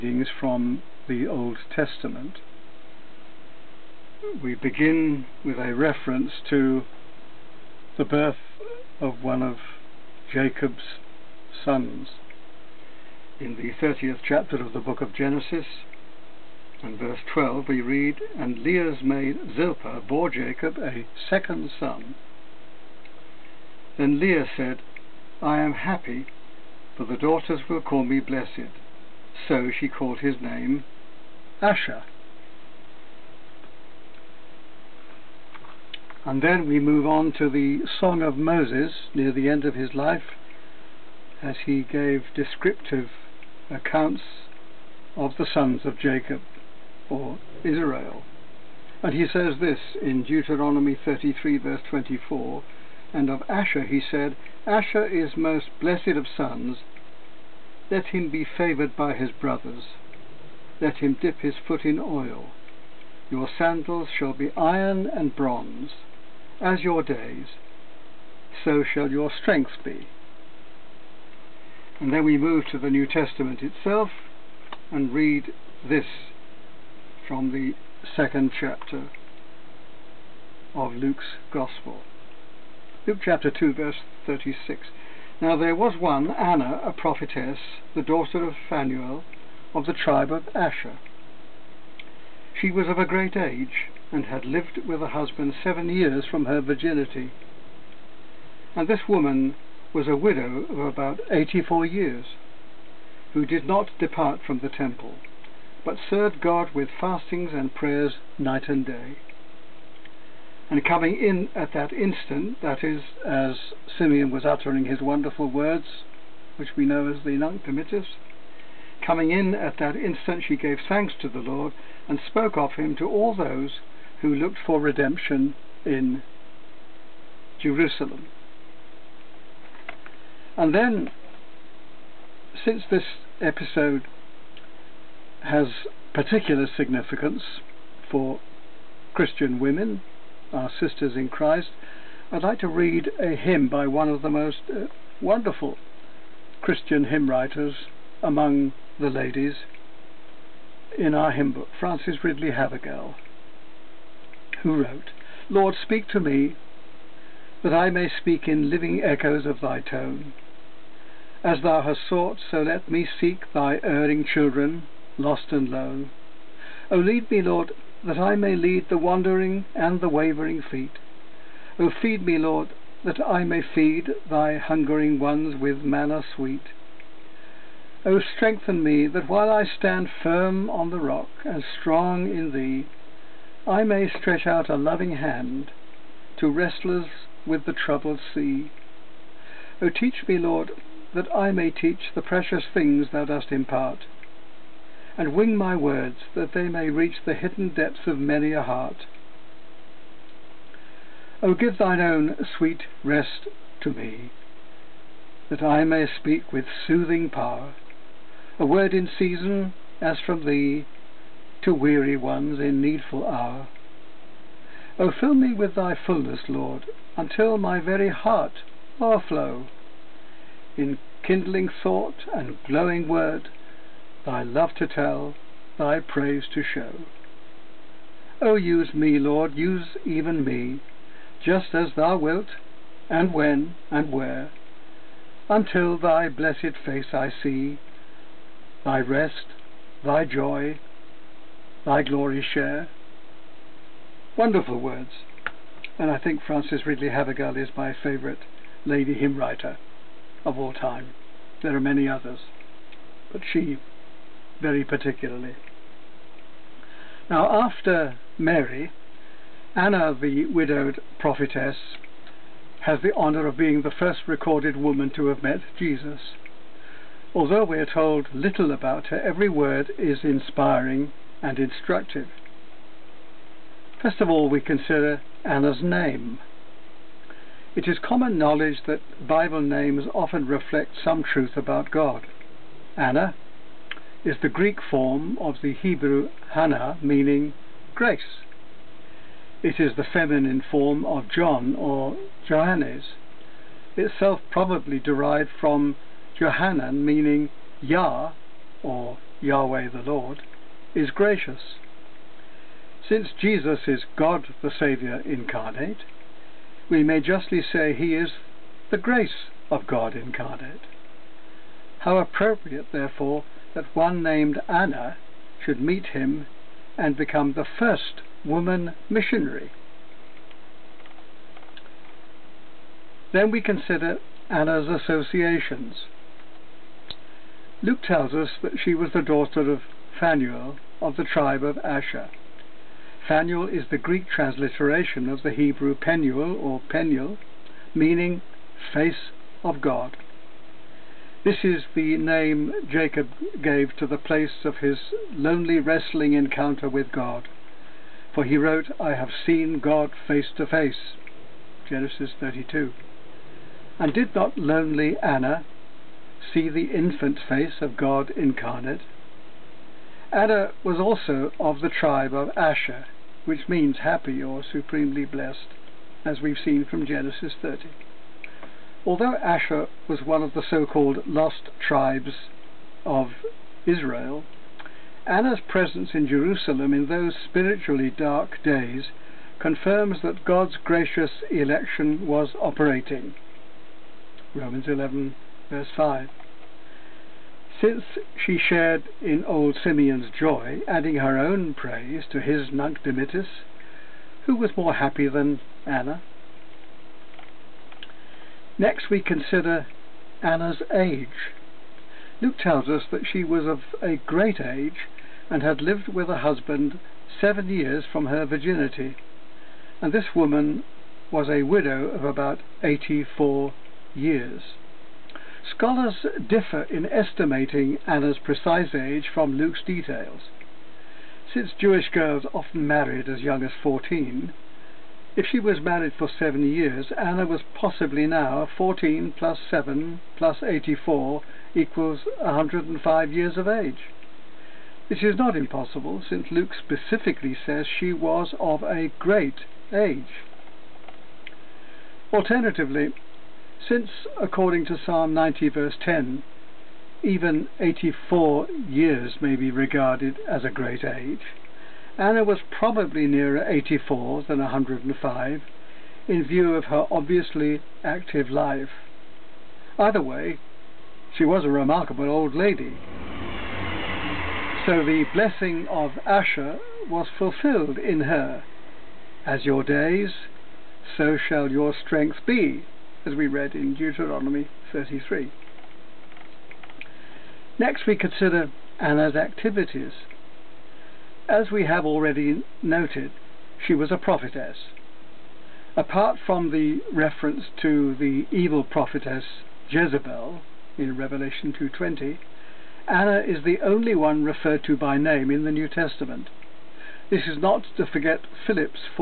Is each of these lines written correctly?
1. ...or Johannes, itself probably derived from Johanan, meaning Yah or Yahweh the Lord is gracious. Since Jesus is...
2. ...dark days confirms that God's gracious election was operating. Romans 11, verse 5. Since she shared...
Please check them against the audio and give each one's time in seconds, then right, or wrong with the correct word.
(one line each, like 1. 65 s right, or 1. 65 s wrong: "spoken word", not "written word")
1. 291 s right
2. 378 s right.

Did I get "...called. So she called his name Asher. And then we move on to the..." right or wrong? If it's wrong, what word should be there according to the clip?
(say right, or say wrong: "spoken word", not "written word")
wrong: "blessed", not "called".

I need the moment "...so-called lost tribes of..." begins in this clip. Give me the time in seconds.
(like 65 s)
370 s.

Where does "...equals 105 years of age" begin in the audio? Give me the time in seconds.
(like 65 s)
431 s.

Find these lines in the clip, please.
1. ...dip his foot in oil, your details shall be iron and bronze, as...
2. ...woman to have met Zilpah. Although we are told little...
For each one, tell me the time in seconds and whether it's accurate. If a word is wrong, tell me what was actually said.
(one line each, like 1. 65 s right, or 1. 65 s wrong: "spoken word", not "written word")
1. 61 s wrong: "sandals", not "details"
2. 264 s wrong: "Jesus", not "Zilpah".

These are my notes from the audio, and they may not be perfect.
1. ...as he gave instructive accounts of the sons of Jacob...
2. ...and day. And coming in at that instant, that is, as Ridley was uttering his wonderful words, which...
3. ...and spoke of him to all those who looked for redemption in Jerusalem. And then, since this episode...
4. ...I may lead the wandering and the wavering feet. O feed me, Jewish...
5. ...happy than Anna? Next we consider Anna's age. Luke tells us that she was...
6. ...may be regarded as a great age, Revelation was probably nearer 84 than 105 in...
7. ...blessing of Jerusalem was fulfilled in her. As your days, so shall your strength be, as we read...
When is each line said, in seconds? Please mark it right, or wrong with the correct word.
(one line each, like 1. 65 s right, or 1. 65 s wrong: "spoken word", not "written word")
1. 41 s wrong: "descriptive", not "instructive"
2. 108 s wrong: "Simeon", not "Ridley"
3. 122 s right
4. 168 s wrong: "Lord", not "Jewish"
5. 394 s right
6. 449 s wrong: "Anna", not "Revelation"
7. 465 s wrong: "Asher", not "Jerusalem".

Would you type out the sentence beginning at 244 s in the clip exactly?
Wonderful words, and I think Frances Ridley Havergal is my favourite lady hymn writer of all time.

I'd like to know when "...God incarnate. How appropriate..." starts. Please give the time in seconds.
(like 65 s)
309 s.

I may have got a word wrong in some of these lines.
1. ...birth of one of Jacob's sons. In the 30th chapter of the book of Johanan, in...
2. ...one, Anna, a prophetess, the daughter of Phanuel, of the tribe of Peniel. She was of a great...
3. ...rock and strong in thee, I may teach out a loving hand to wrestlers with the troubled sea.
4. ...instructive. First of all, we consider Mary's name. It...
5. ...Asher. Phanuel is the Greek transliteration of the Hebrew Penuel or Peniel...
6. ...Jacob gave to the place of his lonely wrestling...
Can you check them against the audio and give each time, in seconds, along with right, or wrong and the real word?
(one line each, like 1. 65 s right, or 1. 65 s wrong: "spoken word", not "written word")
1. 8 s wrong: "Genesis", not "Johanan"
2. 85 s wrong: "Asher", not "Peniel"
3. 180 s wrong: "stretch", not "teach"
4. 271 s wrong: "Anna", not "Mary"
5. 331 s right
6. 342 s right.